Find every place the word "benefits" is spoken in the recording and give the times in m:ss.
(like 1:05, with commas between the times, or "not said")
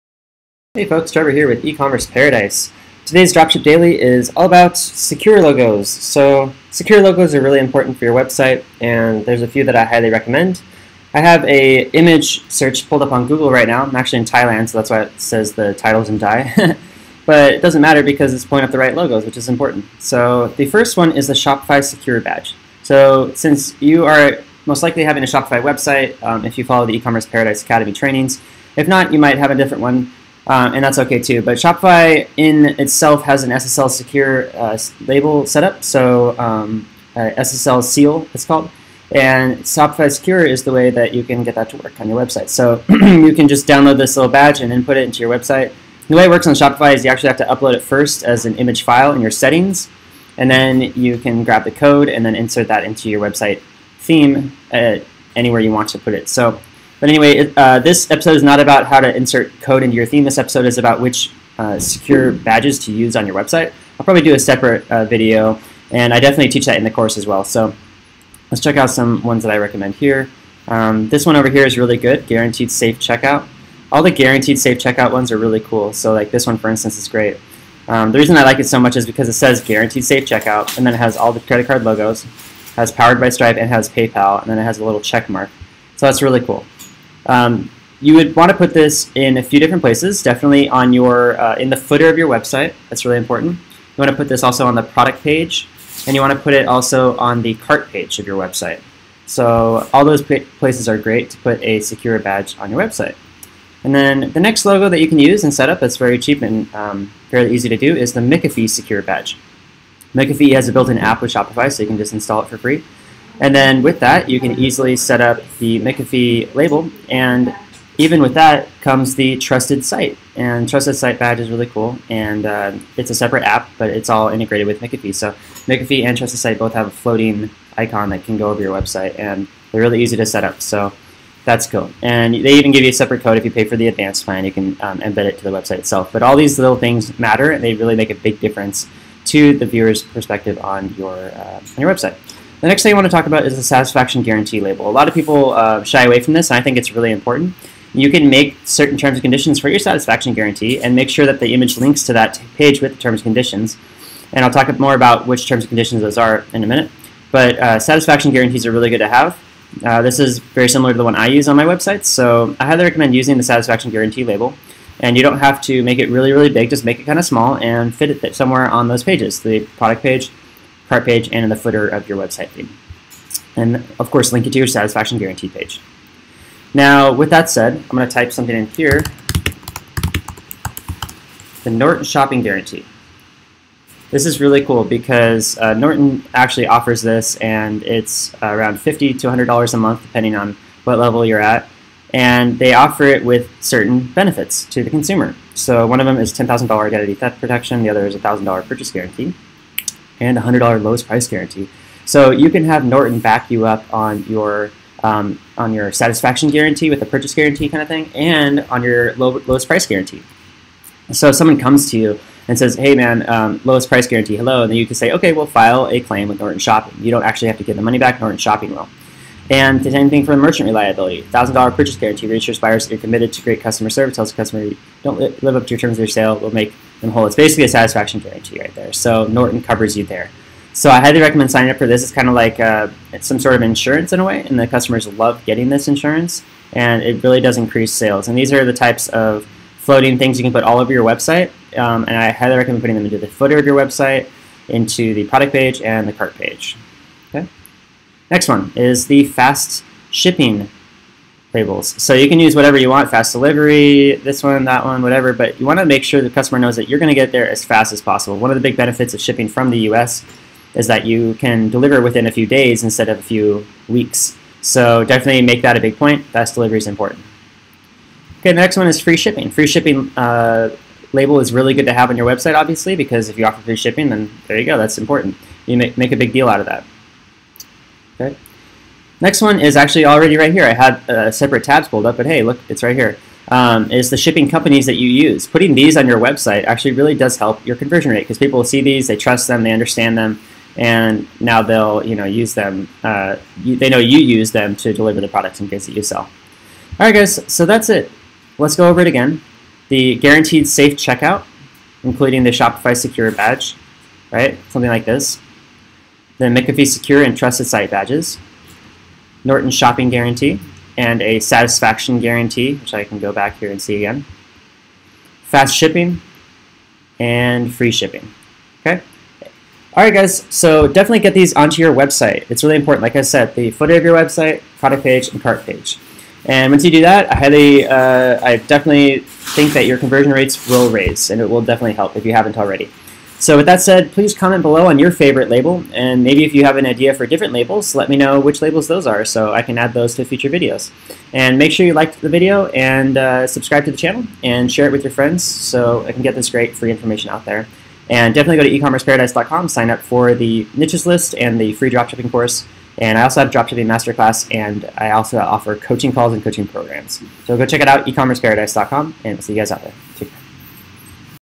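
3:14, 4:18.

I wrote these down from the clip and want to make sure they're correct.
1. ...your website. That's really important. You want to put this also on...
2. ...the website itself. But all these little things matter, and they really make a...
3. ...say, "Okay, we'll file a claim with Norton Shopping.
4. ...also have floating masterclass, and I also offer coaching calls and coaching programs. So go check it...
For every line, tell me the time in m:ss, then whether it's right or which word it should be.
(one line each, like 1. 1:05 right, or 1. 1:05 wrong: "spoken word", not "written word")
1. 1:32 right
2. 2:15 right
3. 3:34 right
4. 5:53 wrong: "dropshipping", not "floating".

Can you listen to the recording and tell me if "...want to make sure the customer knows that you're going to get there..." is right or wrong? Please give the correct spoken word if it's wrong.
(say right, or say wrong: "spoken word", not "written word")
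right.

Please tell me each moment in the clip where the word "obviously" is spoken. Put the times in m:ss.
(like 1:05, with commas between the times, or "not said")
4:32.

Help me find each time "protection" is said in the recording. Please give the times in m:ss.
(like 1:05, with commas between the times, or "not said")
3:17.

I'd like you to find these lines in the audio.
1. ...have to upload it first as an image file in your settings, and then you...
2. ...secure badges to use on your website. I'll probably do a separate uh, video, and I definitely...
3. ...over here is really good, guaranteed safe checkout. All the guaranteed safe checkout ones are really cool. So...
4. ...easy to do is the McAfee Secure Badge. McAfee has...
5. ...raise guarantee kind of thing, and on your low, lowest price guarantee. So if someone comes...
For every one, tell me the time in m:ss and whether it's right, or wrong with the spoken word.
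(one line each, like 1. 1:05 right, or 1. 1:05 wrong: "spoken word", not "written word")
1. 0:47 right
2. 1:01 right
3. 1:11 right
4. 1:47 right
5. 3:27 wrong: "purchase", not "raise".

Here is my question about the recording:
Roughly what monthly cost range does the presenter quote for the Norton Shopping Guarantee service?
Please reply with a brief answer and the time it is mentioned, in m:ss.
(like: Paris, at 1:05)
$50 to $100, at 3:08.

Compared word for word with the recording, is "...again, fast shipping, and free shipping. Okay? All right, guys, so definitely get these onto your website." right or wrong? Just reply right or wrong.
right.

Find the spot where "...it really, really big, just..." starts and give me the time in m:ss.
2:45.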